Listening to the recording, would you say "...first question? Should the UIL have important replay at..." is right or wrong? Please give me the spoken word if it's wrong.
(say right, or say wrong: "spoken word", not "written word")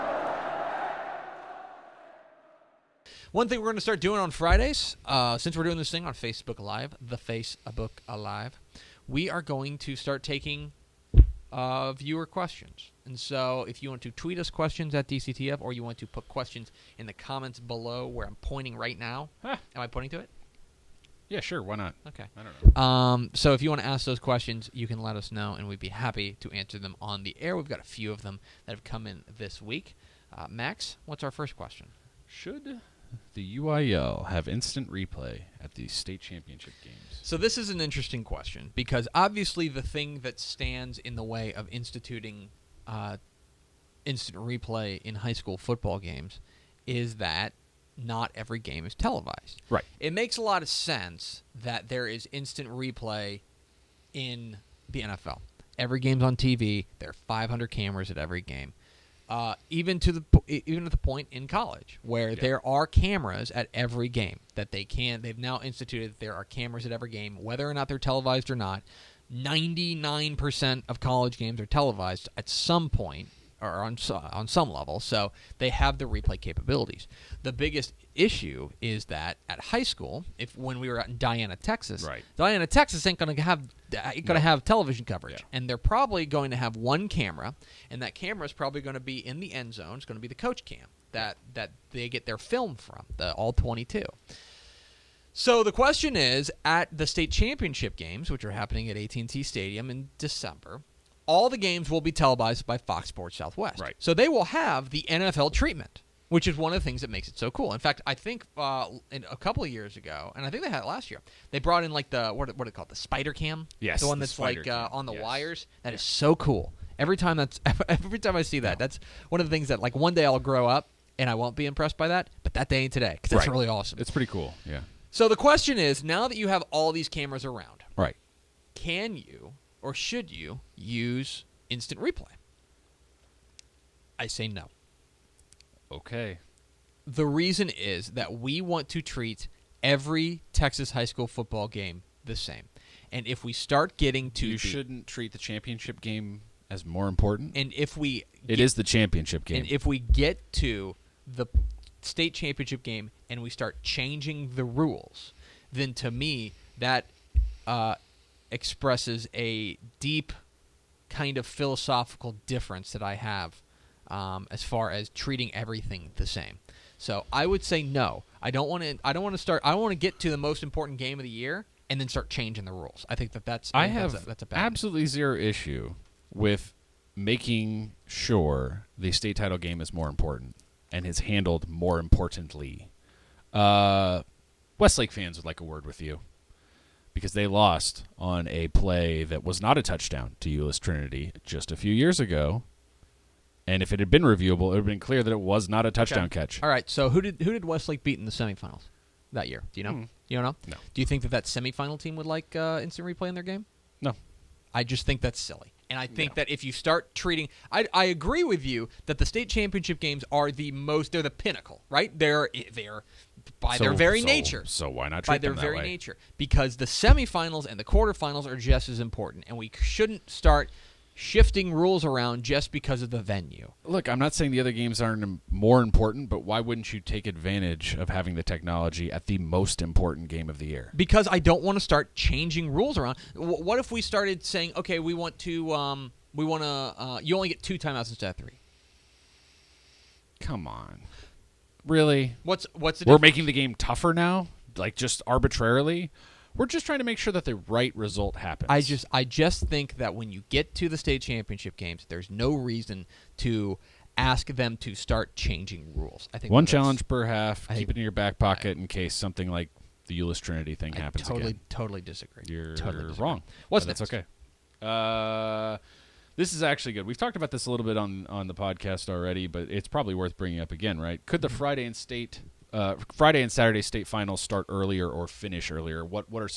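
wrong: "instant", not "important".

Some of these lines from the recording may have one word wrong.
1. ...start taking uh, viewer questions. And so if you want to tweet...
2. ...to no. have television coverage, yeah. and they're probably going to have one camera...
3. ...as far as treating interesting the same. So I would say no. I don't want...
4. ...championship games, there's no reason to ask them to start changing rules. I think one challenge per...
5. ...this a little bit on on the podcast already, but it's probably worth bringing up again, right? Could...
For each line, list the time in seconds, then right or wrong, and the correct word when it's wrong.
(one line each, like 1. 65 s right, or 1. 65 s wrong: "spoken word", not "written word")
1. 9 s right
2. 84 s right
3. 164 s wrong: "everything", not "interesting"
4. 251 s right
5. 267 s right.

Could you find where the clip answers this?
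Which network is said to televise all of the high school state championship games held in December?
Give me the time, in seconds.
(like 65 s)
102 s.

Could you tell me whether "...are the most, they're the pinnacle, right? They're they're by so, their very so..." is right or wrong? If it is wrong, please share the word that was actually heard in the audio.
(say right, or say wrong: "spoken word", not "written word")
right.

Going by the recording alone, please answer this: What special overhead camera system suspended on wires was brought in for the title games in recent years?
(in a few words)
Spider Cam.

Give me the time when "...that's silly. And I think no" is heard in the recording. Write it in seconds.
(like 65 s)
205 s.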